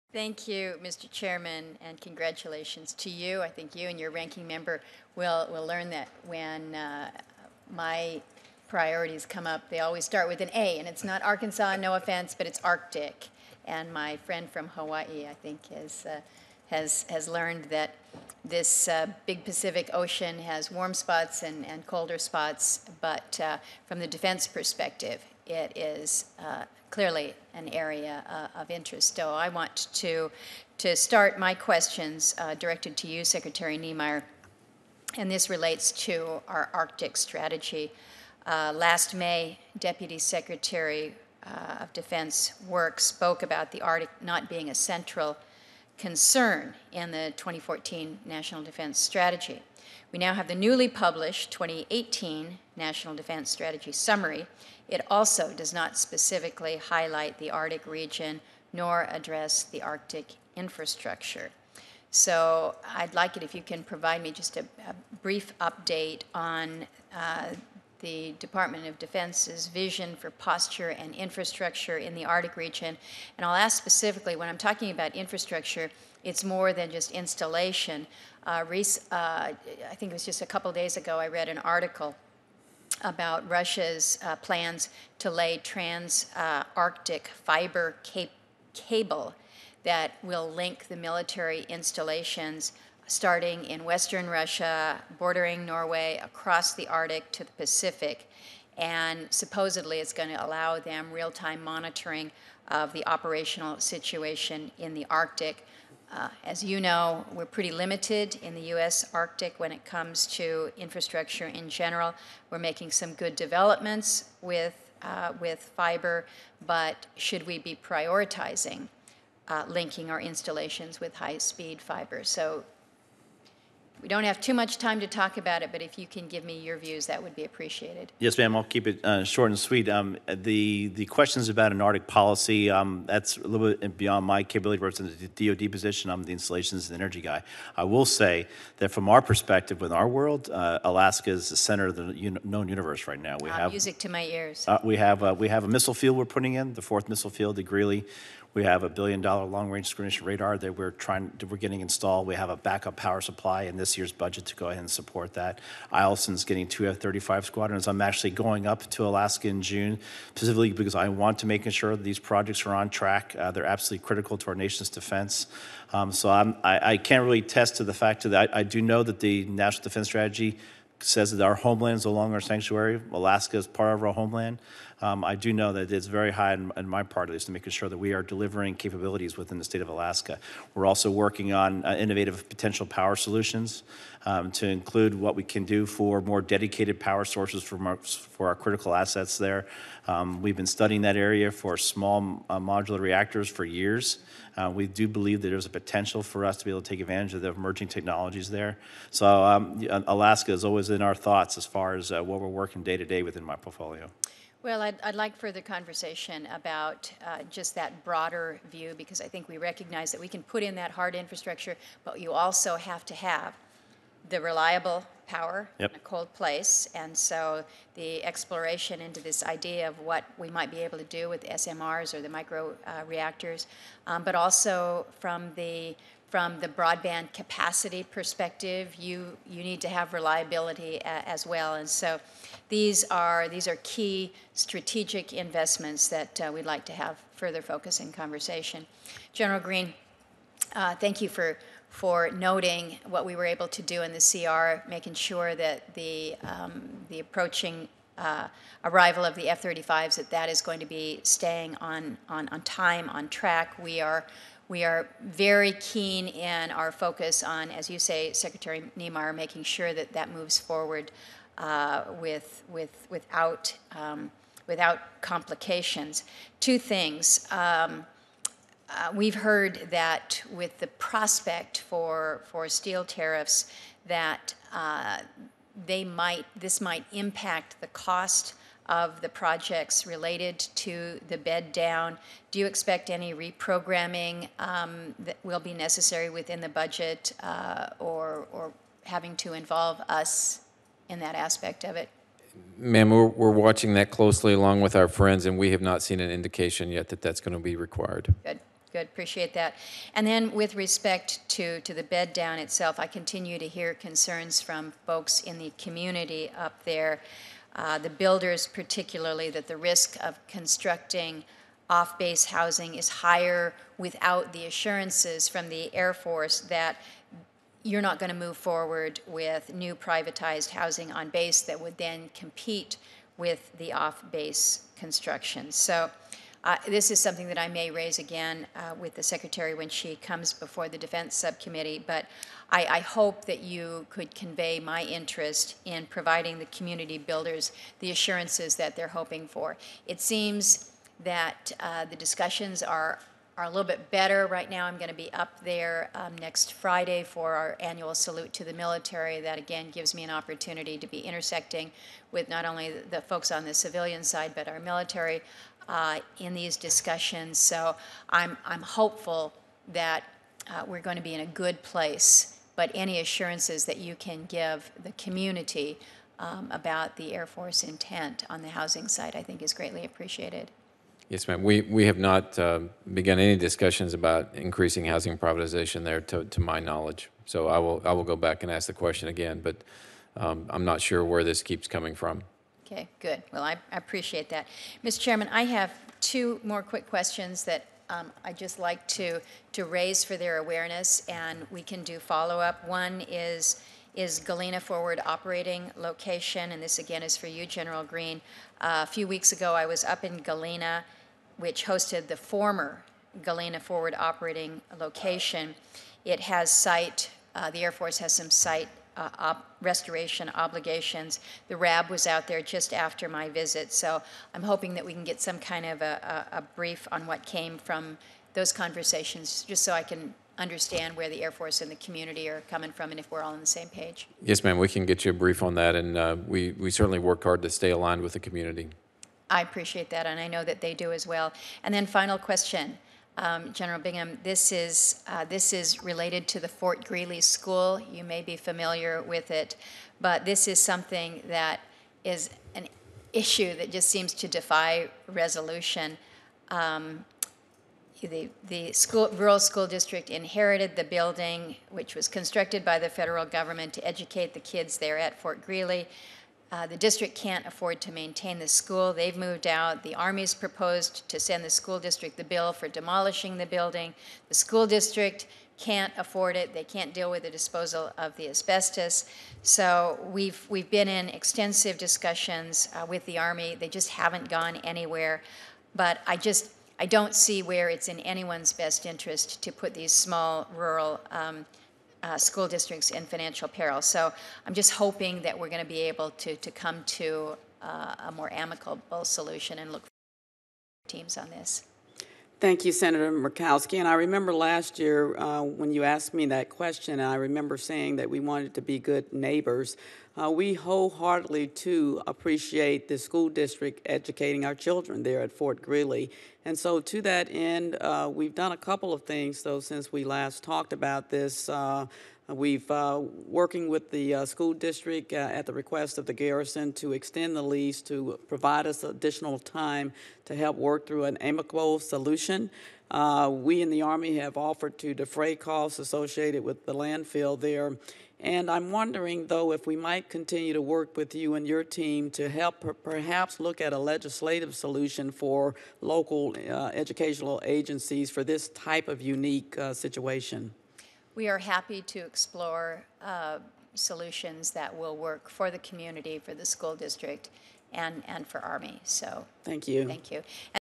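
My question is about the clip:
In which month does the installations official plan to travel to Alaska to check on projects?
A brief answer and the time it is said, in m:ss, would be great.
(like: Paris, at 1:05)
June, at 2:39.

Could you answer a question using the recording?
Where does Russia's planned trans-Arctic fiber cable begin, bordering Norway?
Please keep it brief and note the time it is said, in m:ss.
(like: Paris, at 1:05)
Western Russia, at 1:33.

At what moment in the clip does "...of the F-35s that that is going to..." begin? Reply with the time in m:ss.
4:09.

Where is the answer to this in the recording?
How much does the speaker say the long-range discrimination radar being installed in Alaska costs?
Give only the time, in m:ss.
2:28.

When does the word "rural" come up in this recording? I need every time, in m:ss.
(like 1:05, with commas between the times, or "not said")
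7:29, 8:00.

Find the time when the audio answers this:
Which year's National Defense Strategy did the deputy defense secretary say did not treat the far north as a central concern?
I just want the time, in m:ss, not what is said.
0:47.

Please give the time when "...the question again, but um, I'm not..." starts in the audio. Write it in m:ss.
6:18.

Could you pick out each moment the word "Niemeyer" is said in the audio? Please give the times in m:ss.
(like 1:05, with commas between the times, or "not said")
0:33, 4:18.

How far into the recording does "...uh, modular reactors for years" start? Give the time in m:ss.
3:12.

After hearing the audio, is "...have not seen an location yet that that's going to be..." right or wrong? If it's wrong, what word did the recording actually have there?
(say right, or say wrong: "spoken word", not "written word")
wrong: "indication", not "location".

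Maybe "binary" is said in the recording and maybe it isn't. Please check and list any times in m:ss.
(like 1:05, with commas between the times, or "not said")
not said.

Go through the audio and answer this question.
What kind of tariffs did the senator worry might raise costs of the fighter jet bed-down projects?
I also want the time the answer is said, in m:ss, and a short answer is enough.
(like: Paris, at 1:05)
steel tariffs, at 4:32.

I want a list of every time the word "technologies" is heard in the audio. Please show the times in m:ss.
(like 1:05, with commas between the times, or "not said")
3:17.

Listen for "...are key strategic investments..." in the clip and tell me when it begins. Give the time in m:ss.
3:53.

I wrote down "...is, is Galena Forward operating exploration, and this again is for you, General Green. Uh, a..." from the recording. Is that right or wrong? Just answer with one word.
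wrong.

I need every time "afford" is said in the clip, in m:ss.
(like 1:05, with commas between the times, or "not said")
7:37, 7:46.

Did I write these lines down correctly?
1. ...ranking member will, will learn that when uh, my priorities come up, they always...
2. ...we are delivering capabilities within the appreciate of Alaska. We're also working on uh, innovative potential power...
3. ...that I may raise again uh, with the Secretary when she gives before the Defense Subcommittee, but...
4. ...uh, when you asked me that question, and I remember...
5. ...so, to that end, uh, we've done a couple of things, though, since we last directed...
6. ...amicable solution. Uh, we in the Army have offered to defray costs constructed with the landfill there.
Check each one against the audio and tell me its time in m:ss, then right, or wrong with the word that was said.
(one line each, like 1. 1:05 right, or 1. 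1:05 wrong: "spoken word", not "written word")
1. 0:04 right
2. 2:57 wrong: "state", not "appreciate"
3. 5:27 wrong: "comes", not "gives"
4. 8:15 right
5. 8:26 wrong: "talked", not "directed"
6. 8:41 wrong: "associated", not "constructed".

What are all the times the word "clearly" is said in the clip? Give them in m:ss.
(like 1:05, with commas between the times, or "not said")
0:26.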